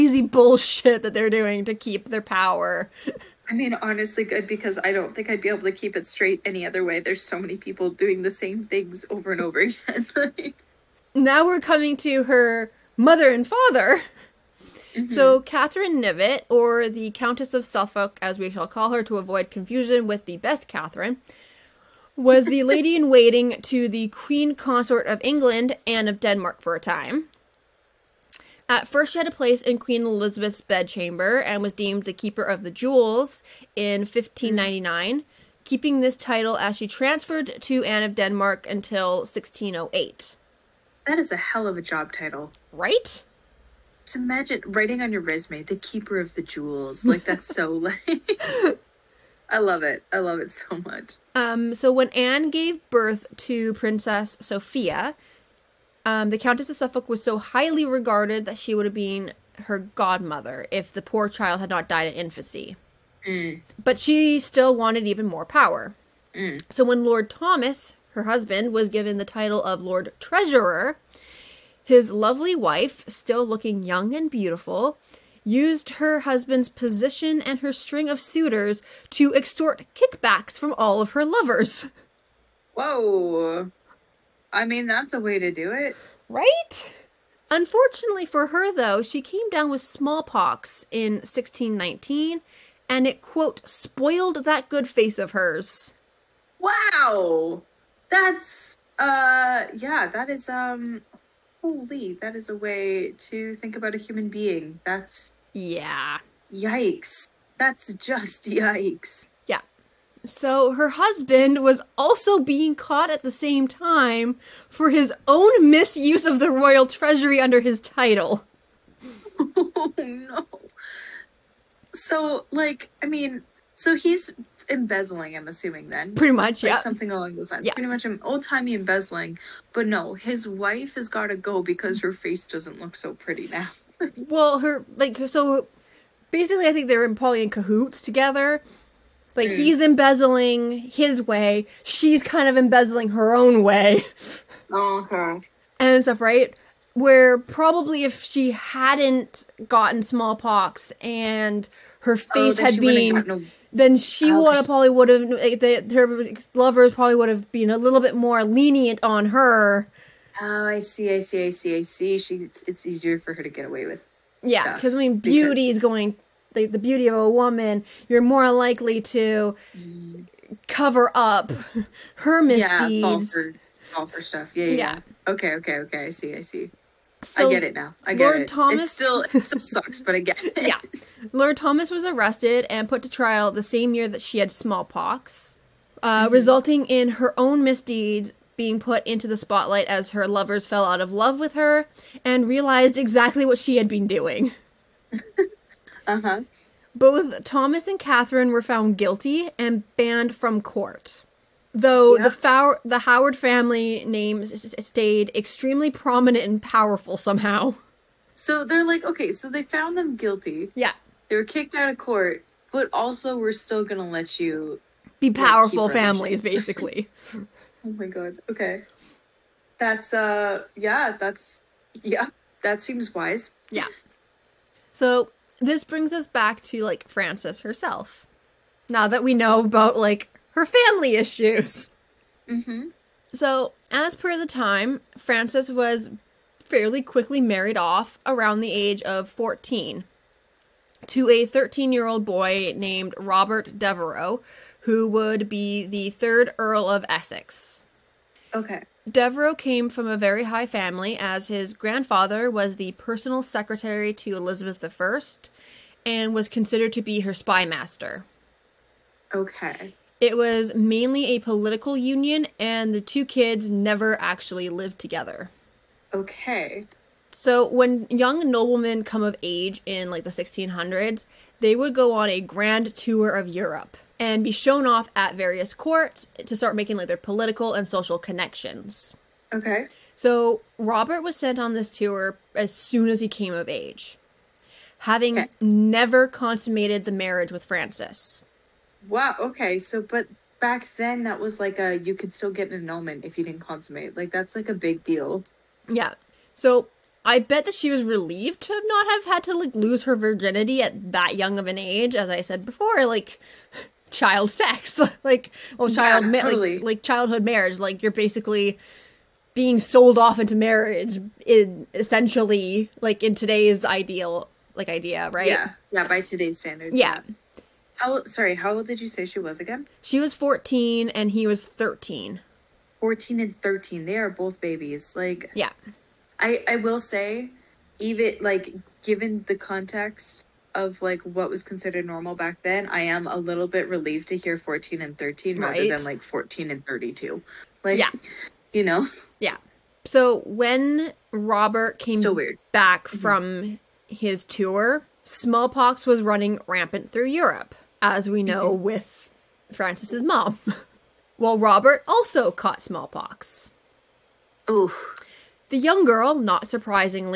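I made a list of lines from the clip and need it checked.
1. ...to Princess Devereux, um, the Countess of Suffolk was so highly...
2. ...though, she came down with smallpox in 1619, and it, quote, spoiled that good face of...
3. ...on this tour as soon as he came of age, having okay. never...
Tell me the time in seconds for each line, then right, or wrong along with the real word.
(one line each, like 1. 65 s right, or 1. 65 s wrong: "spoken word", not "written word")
1. 53 s wrong: "Sophia", not "Devereux"
2. 88 s right
3. 281 s right.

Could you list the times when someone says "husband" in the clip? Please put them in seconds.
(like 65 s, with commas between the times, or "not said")
68 s, 76 s, 110 s.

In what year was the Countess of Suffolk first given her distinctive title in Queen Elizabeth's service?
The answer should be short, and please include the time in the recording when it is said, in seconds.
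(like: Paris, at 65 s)
1599, at 34 s.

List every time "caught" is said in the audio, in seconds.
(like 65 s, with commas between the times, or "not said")
112 s, 352 s.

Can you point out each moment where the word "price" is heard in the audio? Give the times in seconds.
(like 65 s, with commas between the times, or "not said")
not said.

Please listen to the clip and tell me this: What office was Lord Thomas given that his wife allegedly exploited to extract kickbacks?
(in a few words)
Lord Treasurer.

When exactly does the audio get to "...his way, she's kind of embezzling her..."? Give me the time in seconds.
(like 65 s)
140 s.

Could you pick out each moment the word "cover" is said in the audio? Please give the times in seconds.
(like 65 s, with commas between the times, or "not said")
170 s.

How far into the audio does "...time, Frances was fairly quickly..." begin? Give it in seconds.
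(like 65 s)
234 s.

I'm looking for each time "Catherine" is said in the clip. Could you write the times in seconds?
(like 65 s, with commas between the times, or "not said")
15 s, 20 s, 197 s.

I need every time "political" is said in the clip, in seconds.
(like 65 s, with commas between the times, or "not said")
261 s, 277 s.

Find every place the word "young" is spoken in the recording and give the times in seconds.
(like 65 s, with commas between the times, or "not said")
73 s, 268 s, 301 s, 355 s.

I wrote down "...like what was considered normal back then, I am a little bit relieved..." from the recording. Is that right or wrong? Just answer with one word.
right.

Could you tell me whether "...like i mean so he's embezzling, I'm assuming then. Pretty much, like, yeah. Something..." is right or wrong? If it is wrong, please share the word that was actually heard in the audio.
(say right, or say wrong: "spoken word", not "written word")
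right.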